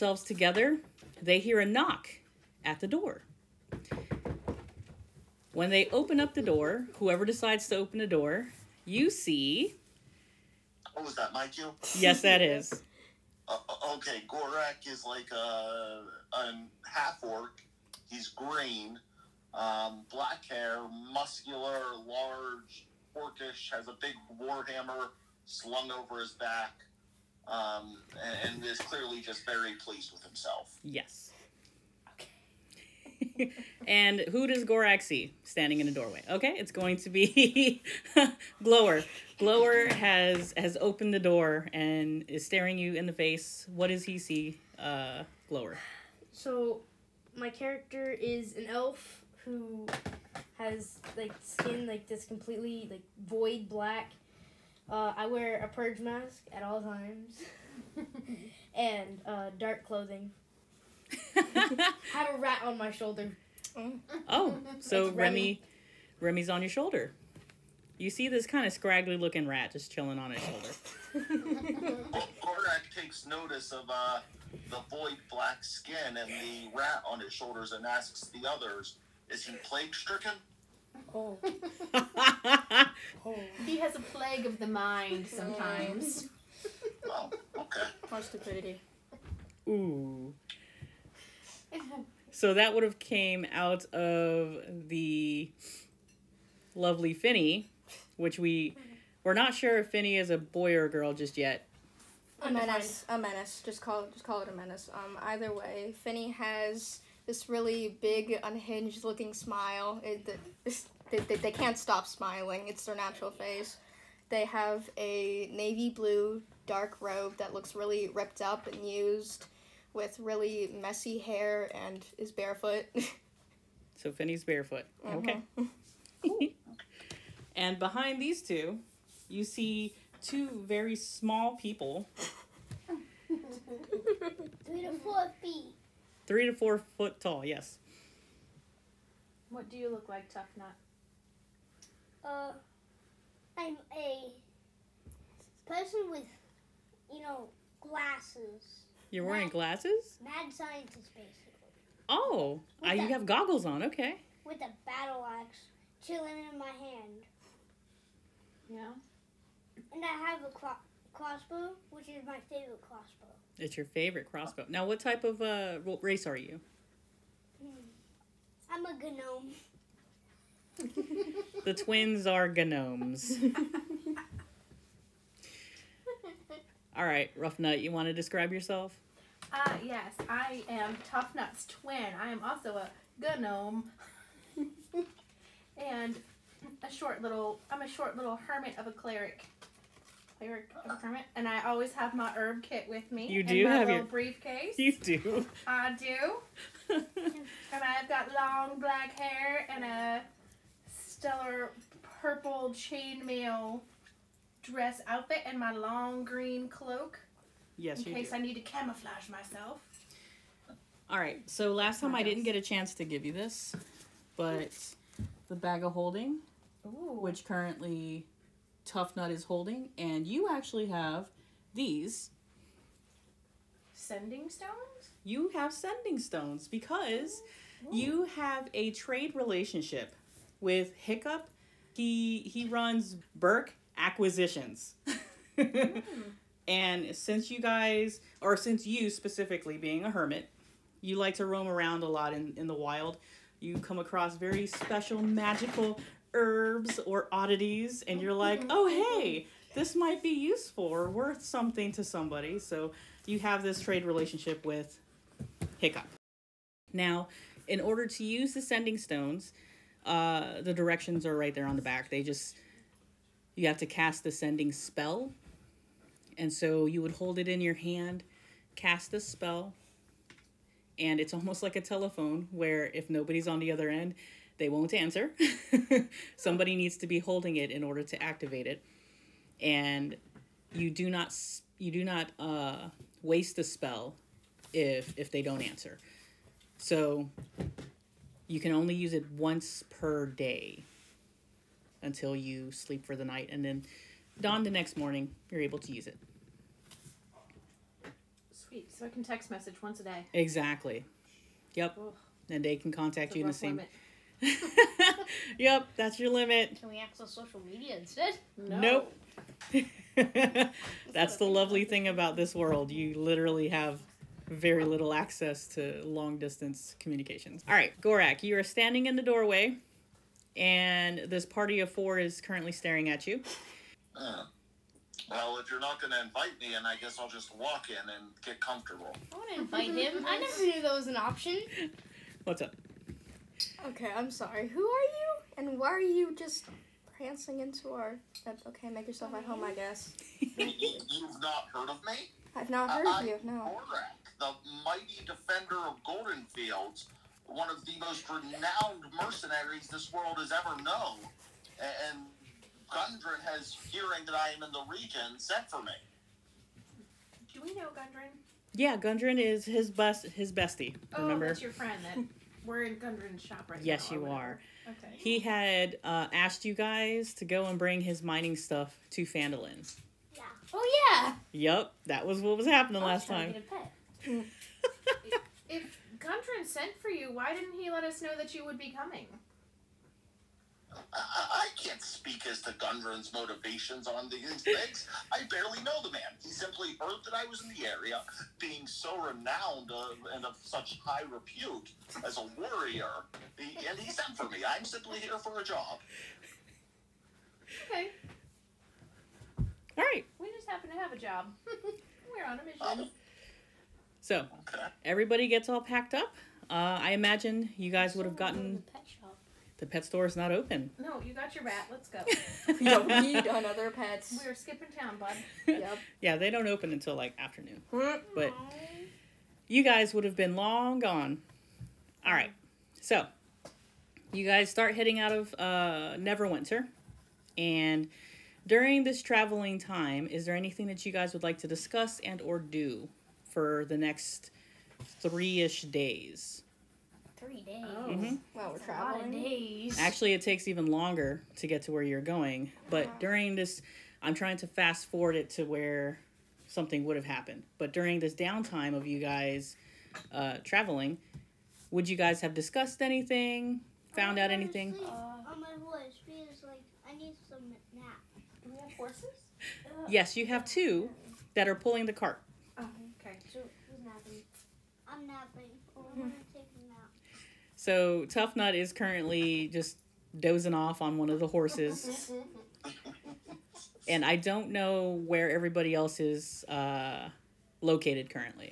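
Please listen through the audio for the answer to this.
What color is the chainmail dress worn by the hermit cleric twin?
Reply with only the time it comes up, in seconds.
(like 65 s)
200 s.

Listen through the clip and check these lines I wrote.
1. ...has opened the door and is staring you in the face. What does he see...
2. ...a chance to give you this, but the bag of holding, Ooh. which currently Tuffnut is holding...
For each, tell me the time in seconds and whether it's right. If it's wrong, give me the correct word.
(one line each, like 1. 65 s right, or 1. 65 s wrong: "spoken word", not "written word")
1. 40 s right
2. 212 s right.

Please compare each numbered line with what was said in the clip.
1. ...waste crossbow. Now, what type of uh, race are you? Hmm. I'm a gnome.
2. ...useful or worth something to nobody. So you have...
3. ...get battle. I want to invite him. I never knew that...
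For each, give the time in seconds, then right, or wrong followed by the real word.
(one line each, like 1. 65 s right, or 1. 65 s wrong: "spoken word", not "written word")
1. 163 s wrong: "favorite", not "waste"
2. 250 s wrong: "somebody", not "nobody"
3. 328 s wrong: "comfortable", not "battle".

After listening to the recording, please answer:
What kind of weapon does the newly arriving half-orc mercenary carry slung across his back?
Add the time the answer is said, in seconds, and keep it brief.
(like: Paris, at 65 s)
warhammer, at 24 s.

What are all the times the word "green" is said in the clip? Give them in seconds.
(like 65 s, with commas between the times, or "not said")
18 s, 206 s.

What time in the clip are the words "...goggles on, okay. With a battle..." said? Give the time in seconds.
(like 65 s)
153 s.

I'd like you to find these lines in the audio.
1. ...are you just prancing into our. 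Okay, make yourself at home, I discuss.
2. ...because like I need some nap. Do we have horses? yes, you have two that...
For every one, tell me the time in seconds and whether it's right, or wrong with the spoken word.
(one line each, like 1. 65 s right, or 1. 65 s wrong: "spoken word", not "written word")
1. 335 s wrong: "guess", not "discuss"
2. 456 s right.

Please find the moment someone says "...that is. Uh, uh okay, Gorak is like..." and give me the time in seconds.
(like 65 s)
12 s.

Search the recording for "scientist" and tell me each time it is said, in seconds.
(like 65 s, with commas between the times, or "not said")
150 s.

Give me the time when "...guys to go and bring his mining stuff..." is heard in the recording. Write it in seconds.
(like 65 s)
366 s.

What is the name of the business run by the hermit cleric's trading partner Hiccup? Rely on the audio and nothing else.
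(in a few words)
Berk acquisitions.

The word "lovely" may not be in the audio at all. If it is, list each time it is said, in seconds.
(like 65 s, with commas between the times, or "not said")
96 s, 311 s.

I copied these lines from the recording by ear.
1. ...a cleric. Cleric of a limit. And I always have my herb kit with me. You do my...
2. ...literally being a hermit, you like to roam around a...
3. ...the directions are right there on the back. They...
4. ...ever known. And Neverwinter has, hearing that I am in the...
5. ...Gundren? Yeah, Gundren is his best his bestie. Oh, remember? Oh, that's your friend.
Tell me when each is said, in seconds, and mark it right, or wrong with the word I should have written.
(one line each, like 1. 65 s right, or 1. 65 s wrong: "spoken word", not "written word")
1. 188 s wrong: "hermit", not "limit"
2. 239 s wrong: "specifically", not "literally"
3. 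260 s right
4. 350 s wrong: "Gundren", not "Neverwinter"
5. 357 s right.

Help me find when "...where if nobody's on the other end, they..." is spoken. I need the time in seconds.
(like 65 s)
272 s.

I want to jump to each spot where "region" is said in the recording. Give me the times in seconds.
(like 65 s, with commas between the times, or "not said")
354 s.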